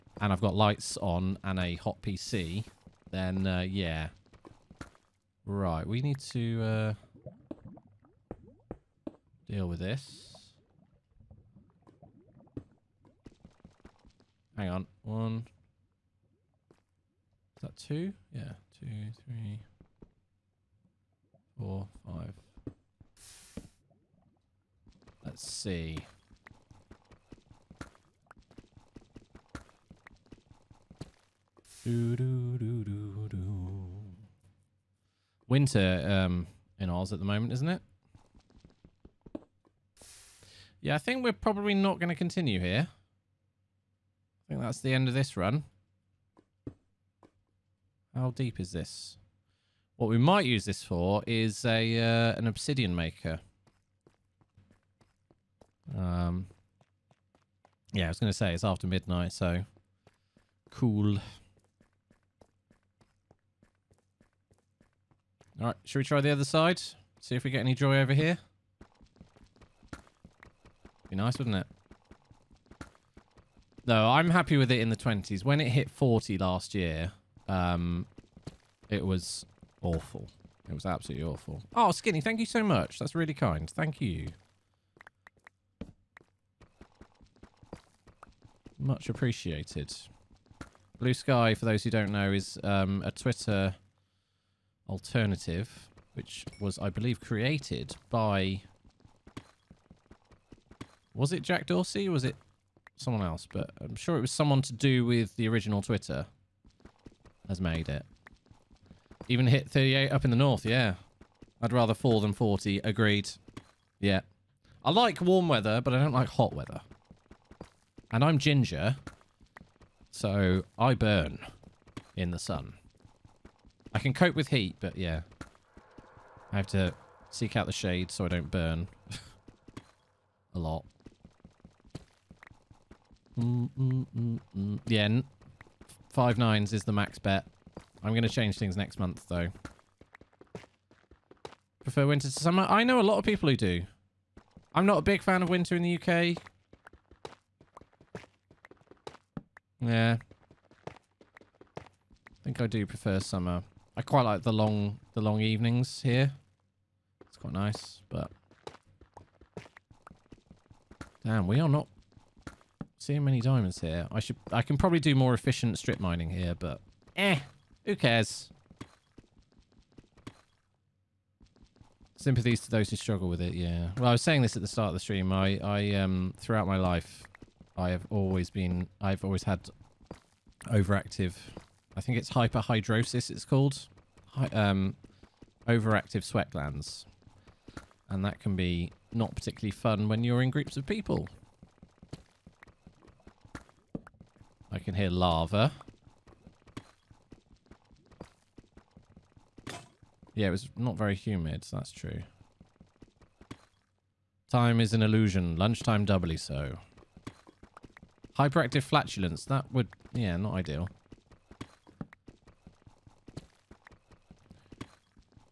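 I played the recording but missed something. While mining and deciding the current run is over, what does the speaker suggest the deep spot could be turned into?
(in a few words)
obsidian maker.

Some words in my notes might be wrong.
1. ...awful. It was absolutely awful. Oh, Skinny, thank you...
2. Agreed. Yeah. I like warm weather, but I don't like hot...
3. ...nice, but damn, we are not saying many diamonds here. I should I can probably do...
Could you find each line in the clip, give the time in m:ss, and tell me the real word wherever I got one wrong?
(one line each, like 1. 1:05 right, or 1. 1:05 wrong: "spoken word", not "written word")
1. 1:19 right
2. 1:52 right
3. 2:37 wrong: "seeing", not "saying".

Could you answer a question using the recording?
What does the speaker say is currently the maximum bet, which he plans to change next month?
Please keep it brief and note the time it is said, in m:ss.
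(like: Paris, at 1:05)
five nines, at 2:16.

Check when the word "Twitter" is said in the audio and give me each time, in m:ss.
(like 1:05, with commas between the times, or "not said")
1:33, 1:45.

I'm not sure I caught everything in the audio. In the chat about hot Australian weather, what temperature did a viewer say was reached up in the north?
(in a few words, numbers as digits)
38.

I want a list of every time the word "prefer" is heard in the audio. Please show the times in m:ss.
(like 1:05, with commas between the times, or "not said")
2:21, 2:32.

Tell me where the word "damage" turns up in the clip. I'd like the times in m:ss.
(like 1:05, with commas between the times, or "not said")
not said.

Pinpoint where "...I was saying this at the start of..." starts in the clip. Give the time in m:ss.
2:54.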